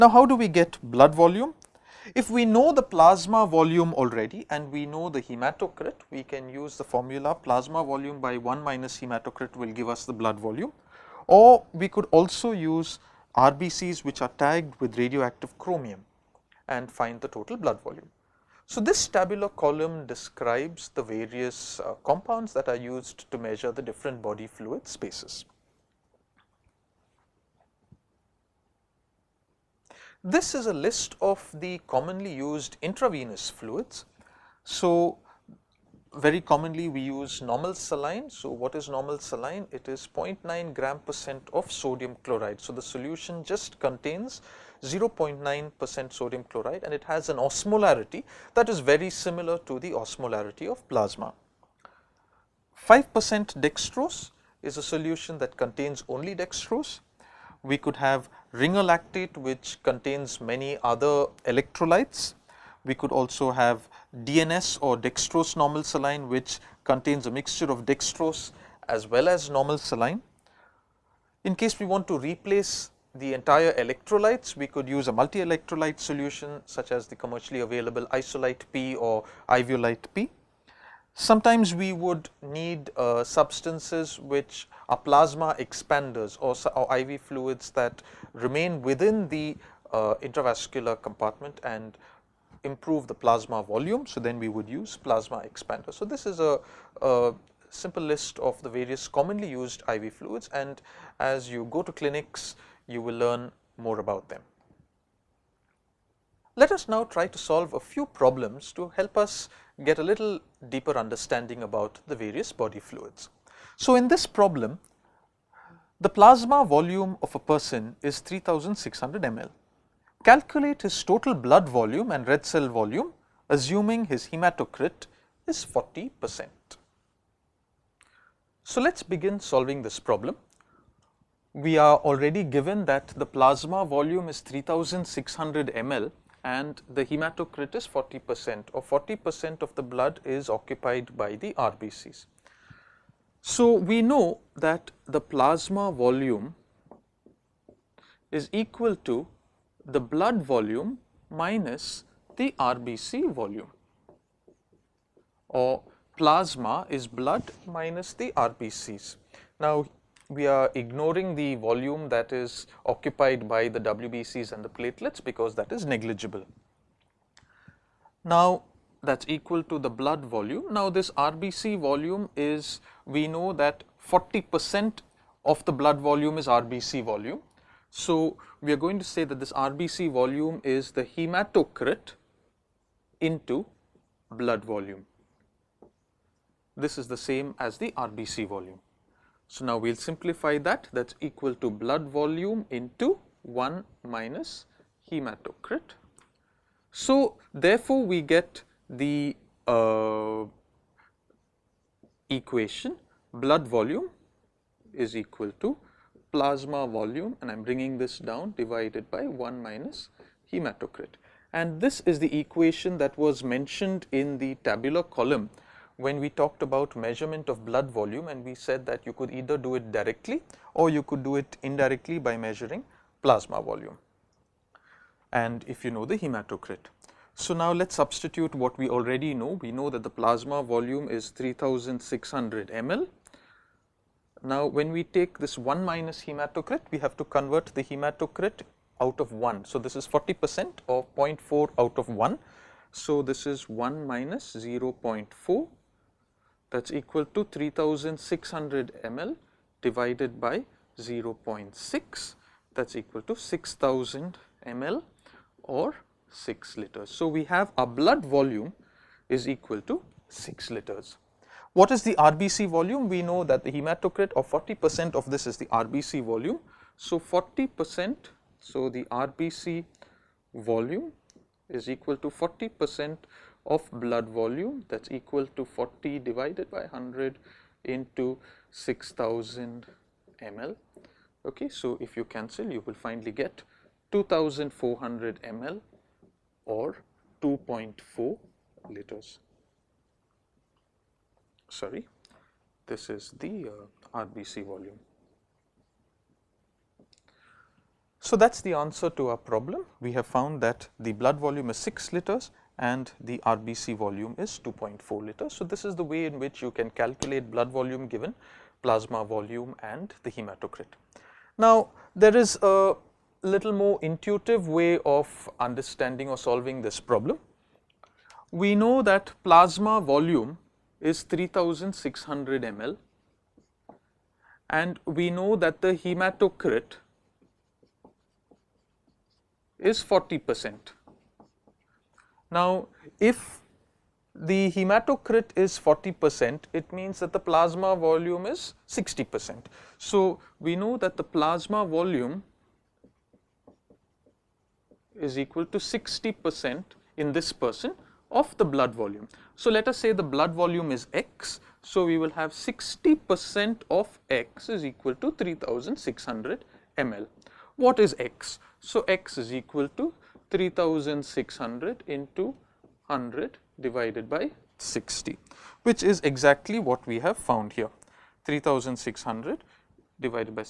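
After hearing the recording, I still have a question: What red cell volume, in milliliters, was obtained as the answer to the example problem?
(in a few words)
2400 ml.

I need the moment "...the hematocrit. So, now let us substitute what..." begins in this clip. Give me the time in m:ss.
3:46.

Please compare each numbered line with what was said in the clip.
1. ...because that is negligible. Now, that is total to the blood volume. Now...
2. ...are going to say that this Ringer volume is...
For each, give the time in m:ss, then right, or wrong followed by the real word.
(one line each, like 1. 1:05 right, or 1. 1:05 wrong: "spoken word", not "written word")
1. 2:45 wrong: "equal", not "total"
2. 2:58 wrong: "RBC", not "Ringer".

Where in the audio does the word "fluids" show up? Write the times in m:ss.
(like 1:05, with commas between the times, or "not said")
0:24, 0:33, 1:27, 1:40, 1:52.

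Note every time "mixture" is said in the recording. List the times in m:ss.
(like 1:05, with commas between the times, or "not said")
1:07.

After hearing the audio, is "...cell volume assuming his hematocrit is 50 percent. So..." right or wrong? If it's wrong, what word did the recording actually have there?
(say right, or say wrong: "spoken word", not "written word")
wrong: "40", not "50".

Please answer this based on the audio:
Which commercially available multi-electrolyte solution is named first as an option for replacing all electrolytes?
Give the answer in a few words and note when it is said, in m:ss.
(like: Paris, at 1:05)
Isolyte P, at 1:18.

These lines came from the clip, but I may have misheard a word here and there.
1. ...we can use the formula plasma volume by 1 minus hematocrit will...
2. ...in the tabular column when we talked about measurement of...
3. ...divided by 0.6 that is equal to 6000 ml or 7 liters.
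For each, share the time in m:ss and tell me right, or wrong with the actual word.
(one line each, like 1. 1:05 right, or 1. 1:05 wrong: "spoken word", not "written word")
1. 0:06 right
2. 3:34 right
3. 4:09 wrong: "6", not "7".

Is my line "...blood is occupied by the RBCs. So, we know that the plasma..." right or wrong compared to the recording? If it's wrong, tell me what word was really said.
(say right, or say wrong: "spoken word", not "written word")
right.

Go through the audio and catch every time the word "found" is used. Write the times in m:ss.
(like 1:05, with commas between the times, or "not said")
5:00, 6:07.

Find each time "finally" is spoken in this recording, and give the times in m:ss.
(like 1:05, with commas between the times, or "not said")
4:42.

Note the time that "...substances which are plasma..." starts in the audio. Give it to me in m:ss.
1:23.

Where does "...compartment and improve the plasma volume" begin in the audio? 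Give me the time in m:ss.
1:31.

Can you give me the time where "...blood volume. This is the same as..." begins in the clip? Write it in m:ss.
3:04.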